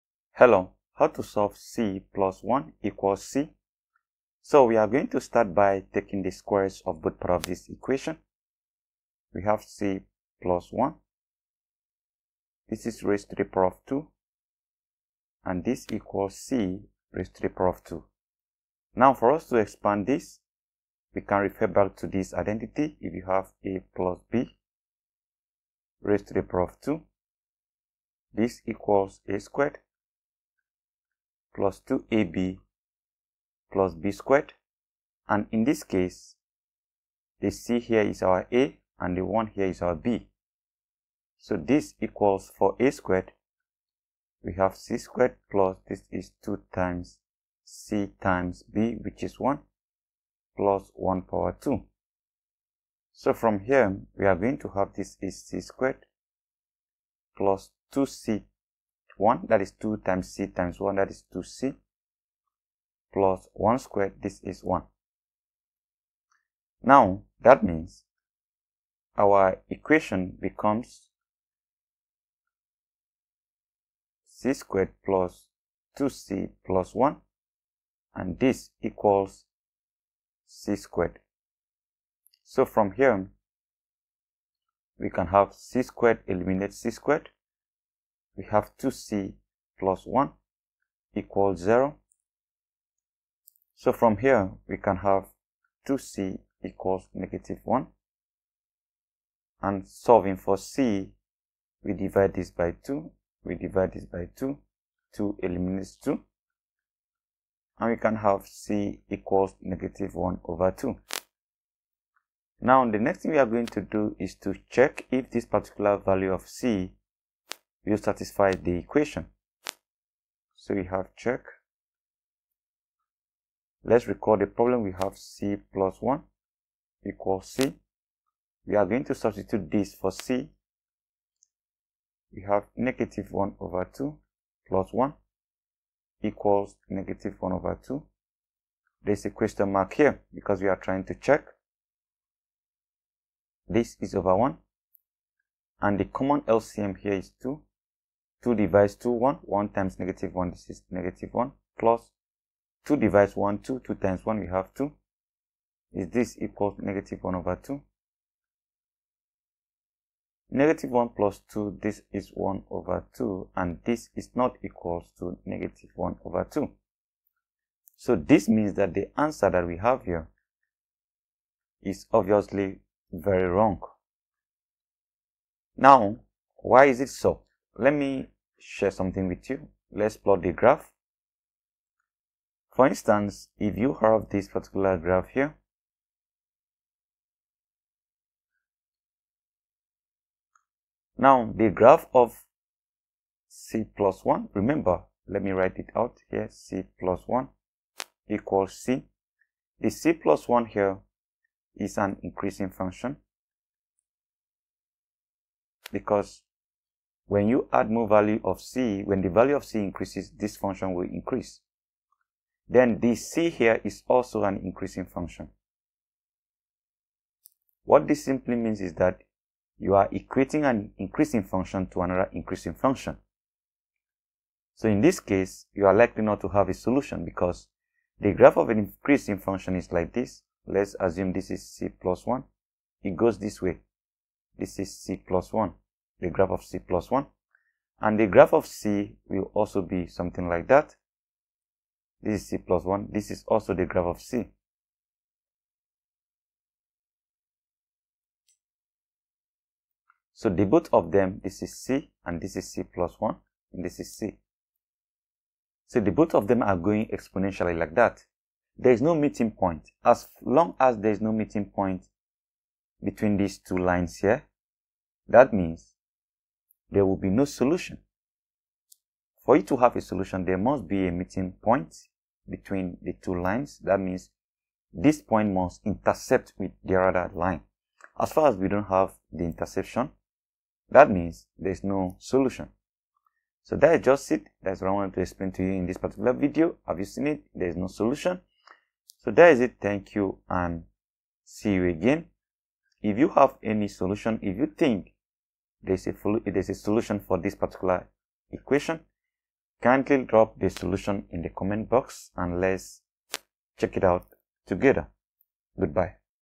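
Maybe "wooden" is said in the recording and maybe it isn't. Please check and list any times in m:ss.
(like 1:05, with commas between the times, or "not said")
not said.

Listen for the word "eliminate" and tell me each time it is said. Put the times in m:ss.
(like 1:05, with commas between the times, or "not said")
1:26, 1:45.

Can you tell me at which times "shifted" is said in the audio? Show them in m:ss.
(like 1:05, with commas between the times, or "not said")
not said.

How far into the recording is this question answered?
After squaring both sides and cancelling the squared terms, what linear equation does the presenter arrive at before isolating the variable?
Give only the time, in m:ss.
1:28.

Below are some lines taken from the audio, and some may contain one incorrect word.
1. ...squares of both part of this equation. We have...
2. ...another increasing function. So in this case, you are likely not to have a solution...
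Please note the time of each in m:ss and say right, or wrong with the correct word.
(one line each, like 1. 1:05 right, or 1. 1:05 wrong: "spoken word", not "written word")
1. 0:06 right
2. 3:42 right.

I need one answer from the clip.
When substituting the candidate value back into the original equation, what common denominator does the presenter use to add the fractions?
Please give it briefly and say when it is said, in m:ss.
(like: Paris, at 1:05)
2, at 2:25.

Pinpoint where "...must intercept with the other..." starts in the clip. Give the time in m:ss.
4:35.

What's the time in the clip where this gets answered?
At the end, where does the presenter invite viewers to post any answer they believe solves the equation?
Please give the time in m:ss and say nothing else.
5:01.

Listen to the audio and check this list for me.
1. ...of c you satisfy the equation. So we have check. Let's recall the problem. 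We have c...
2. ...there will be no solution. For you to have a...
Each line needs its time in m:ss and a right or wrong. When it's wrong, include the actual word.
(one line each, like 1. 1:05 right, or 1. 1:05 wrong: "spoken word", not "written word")
1. 1:56 right
2. 4:26 right.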